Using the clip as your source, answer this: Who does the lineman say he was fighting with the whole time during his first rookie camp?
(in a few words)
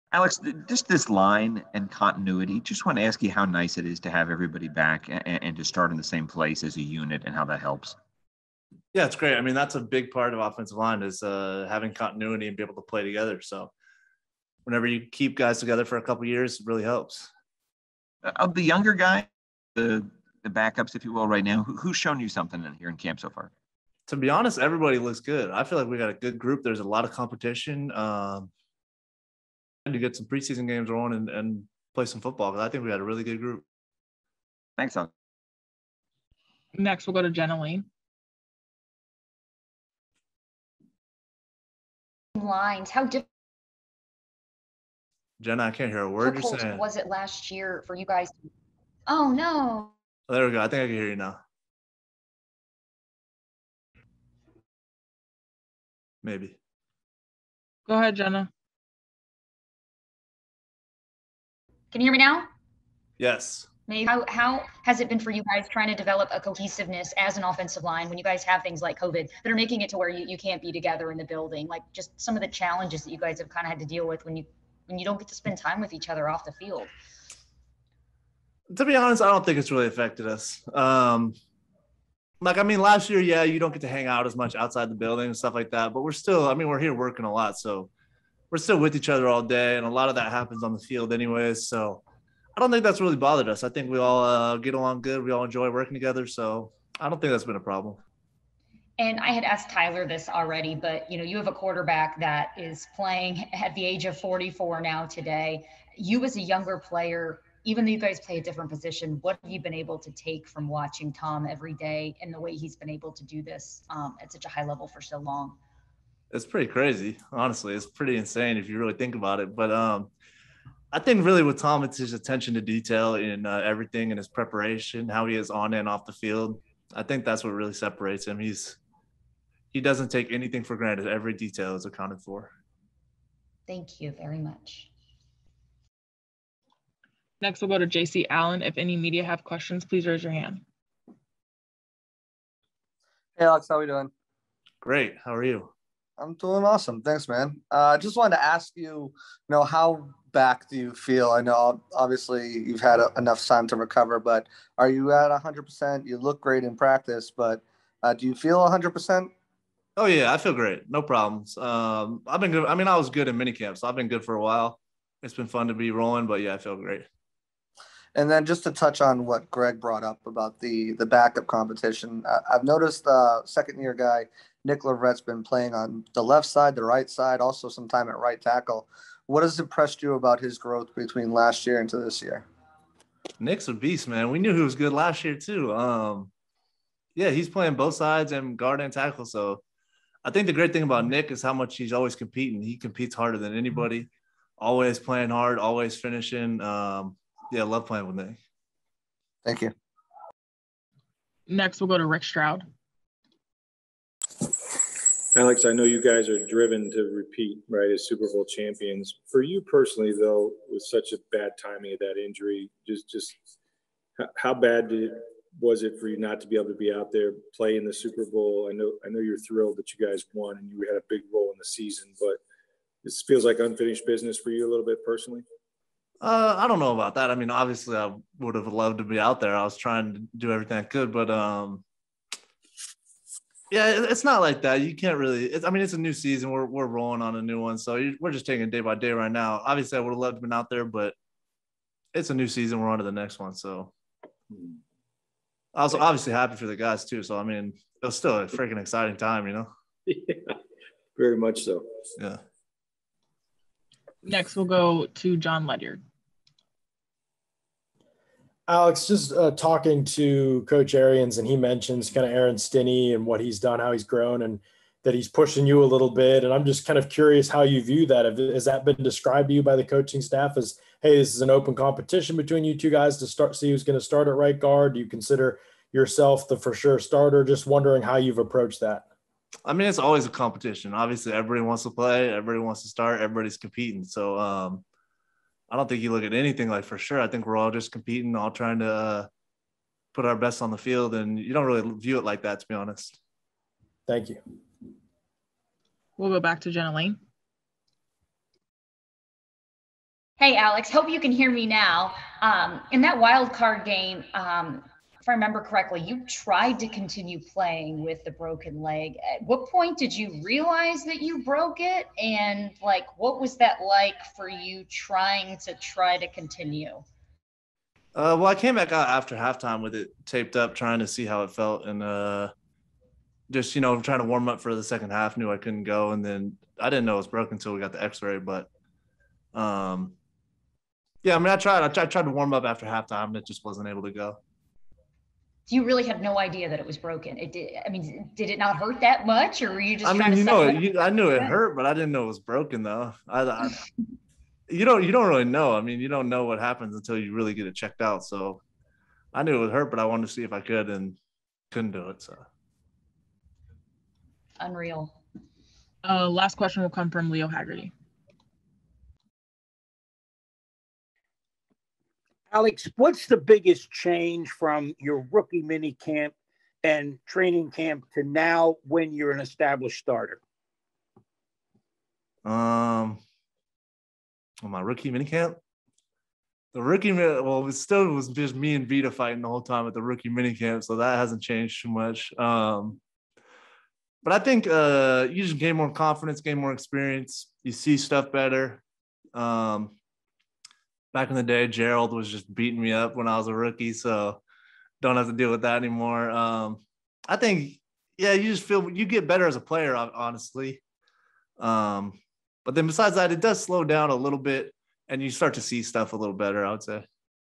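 Vita.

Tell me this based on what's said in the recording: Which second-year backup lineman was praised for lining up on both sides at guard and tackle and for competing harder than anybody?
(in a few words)
Nick Leverett.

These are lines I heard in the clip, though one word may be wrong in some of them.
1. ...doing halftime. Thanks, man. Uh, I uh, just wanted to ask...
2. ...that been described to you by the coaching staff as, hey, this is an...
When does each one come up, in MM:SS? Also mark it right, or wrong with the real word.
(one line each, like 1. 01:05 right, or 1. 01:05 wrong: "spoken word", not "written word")
1. 02:26 wrong: "awesome", not "halftime"
2. 04:28 right.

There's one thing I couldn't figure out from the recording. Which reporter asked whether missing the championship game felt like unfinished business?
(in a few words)
Rick Stroud.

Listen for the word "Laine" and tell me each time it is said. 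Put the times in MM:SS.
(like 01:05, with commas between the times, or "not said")
00:37, 04:56.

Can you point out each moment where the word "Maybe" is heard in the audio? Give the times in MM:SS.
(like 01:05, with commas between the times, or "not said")
00:56, 01:03.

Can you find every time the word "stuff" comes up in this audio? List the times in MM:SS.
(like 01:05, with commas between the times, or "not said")
01:25, 06:27, 06:45.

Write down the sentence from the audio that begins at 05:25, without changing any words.
Knew I couldn't go, and then I didn't know it was broken until we got the X-ray.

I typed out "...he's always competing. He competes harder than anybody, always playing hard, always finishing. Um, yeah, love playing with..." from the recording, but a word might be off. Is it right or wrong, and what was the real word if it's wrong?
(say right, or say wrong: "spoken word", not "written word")
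right.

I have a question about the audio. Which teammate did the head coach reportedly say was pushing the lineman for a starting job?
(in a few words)
Aaron Stinnie.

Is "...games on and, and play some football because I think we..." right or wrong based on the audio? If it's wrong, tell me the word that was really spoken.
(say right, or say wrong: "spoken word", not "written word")
right.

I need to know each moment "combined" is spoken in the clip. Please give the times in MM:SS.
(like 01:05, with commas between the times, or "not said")
not said.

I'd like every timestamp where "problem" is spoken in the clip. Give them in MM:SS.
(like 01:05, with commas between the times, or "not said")
01:37, 02:41.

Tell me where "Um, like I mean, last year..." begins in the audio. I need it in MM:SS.
01:20.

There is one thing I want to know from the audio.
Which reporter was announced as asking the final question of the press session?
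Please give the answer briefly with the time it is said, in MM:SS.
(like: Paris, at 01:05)
Leo Haggerty, at 05:57.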